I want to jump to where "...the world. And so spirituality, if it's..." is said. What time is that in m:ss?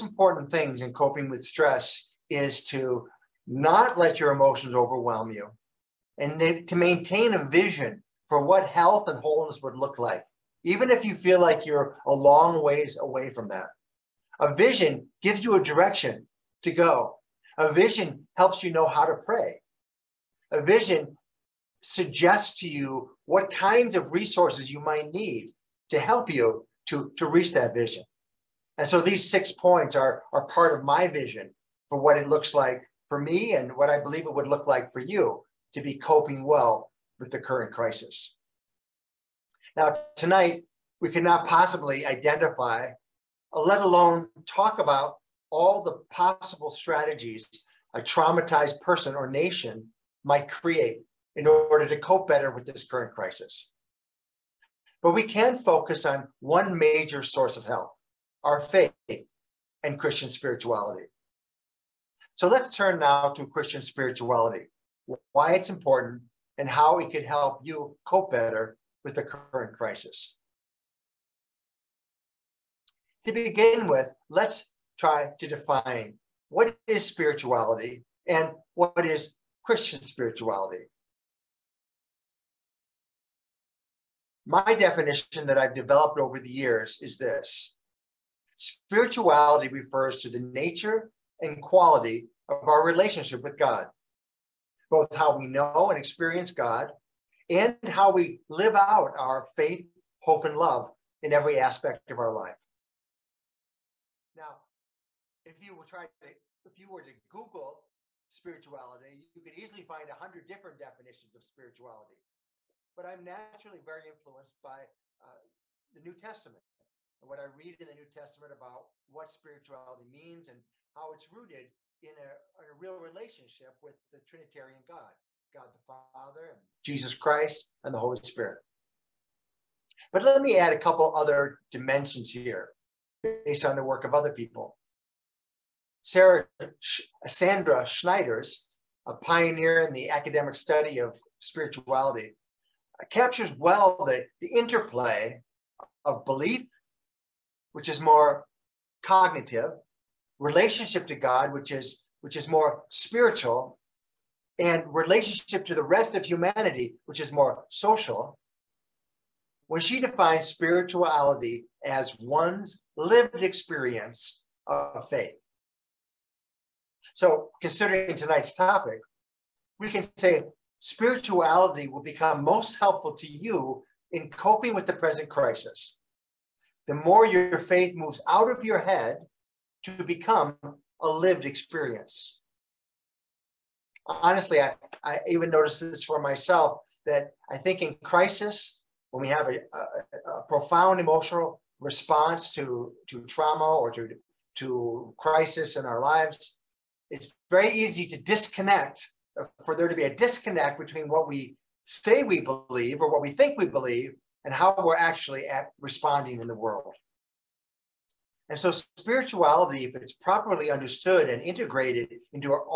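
3:26.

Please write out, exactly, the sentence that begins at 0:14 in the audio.
A vision gives you a direction to go.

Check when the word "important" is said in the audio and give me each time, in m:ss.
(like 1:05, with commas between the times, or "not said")
0:00, 1:05.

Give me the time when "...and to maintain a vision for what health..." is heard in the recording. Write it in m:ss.
0:06.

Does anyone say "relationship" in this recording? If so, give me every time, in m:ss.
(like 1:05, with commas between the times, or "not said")
1:32, 2:02, 2:30, 2:34.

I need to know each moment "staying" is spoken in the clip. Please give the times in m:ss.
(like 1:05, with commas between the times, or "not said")
not said.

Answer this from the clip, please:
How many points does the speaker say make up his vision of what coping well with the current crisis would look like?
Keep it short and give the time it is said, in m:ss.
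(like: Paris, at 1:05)
6, at 0:29.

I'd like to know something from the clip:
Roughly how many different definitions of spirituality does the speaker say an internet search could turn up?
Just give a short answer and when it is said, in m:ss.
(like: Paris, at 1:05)
100, at 1:50.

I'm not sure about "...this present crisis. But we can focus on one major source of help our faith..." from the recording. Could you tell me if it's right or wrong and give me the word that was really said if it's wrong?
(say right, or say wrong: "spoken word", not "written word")
wrong: "current", not "present".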